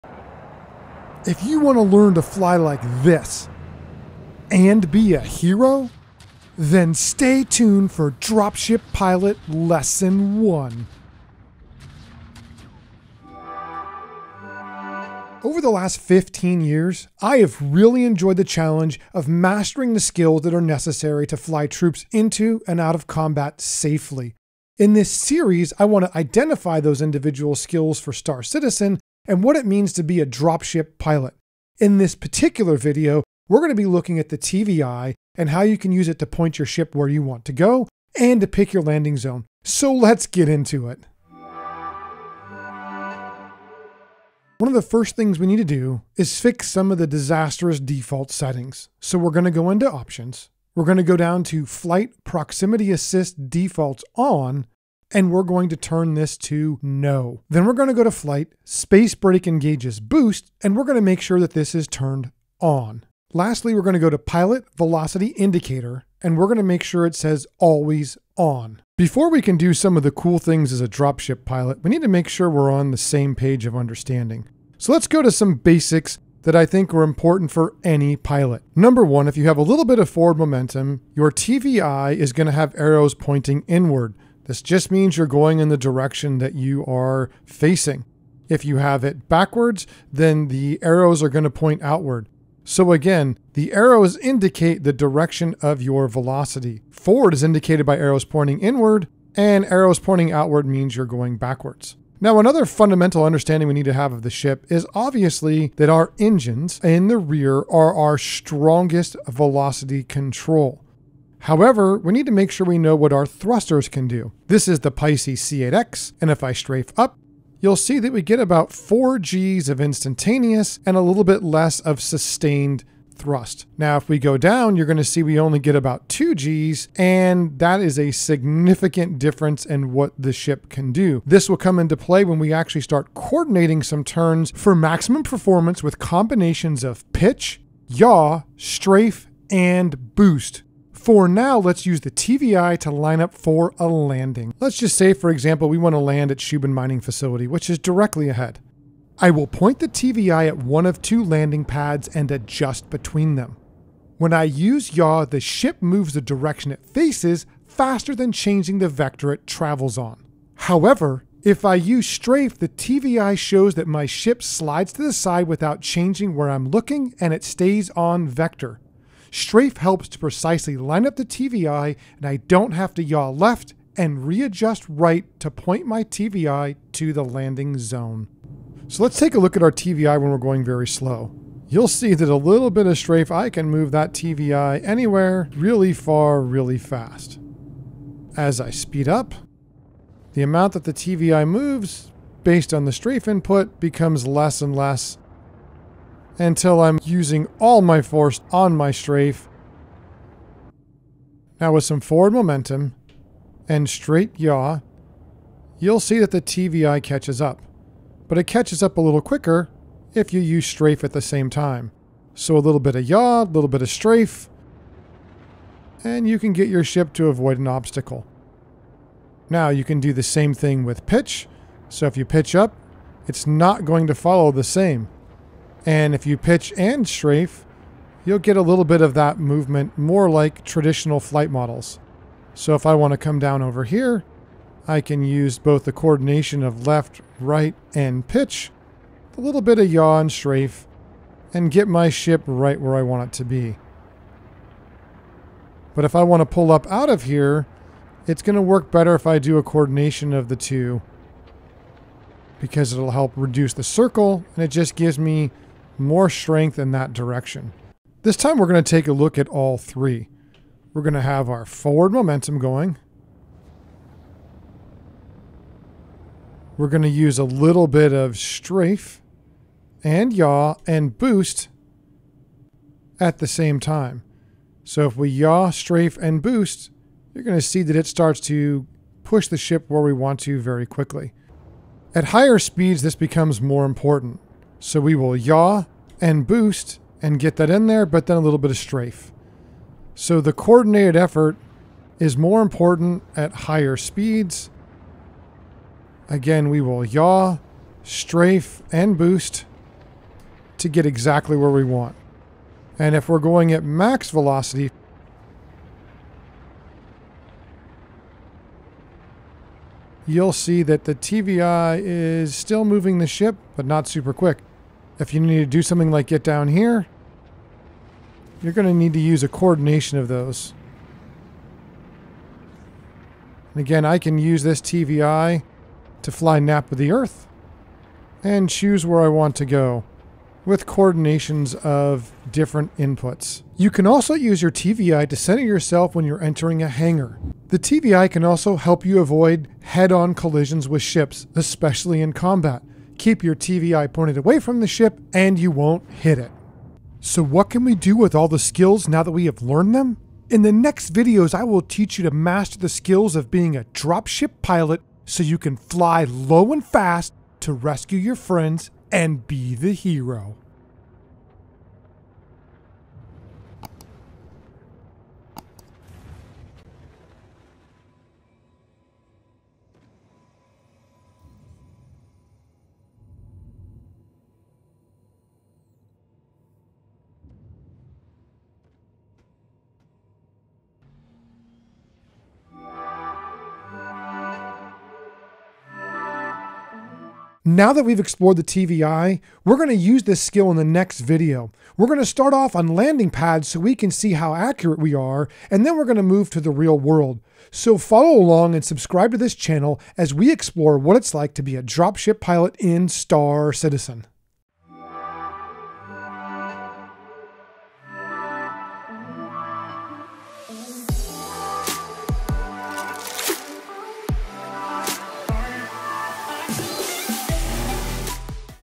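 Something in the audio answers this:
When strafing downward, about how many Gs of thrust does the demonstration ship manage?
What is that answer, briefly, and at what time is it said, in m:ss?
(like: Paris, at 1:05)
2, at 2:06.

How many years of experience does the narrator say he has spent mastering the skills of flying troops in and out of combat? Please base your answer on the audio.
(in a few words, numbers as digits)
15.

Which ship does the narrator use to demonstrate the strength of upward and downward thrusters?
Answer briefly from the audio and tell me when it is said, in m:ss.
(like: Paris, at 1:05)
Pisces C8X, at 1:54.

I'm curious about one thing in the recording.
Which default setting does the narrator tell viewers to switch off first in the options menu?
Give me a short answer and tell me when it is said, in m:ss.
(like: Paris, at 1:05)
Proximity assist, at 0:52.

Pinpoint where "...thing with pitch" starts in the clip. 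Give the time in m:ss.
3:40.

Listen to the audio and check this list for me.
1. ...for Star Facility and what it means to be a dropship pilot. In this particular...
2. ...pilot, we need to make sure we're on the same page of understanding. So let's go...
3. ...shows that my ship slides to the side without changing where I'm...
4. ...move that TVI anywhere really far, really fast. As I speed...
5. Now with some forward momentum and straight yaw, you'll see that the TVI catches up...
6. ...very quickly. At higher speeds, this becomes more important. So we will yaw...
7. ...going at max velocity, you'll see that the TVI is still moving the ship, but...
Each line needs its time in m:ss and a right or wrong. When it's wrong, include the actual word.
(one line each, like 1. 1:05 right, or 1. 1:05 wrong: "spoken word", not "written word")
1. 0:27 wrong: "Citizen", not "Facility"
2. 1:11 right
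3. 2:43 right
4. 3:03 right
5. 3:21 right
6. 4:40 right
7. 5:03 right.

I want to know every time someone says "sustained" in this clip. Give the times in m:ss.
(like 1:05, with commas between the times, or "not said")
2:01.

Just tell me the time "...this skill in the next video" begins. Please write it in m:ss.
6:30.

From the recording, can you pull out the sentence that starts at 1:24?
This just means you're going in the direction that you are facing.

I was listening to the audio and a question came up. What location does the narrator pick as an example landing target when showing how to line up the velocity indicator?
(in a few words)
Shubin Mining Facility.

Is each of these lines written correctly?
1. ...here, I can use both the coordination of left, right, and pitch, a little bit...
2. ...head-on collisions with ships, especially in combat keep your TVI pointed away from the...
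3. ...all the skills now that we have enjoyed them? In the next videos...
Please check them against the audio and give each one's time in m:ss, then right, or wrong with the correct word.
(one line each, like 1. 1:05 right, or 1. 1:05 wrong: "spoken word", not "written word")
1. 3:53 right
2. 5:39 right
3. 5:48 wrong: "learned", not "enjoyed".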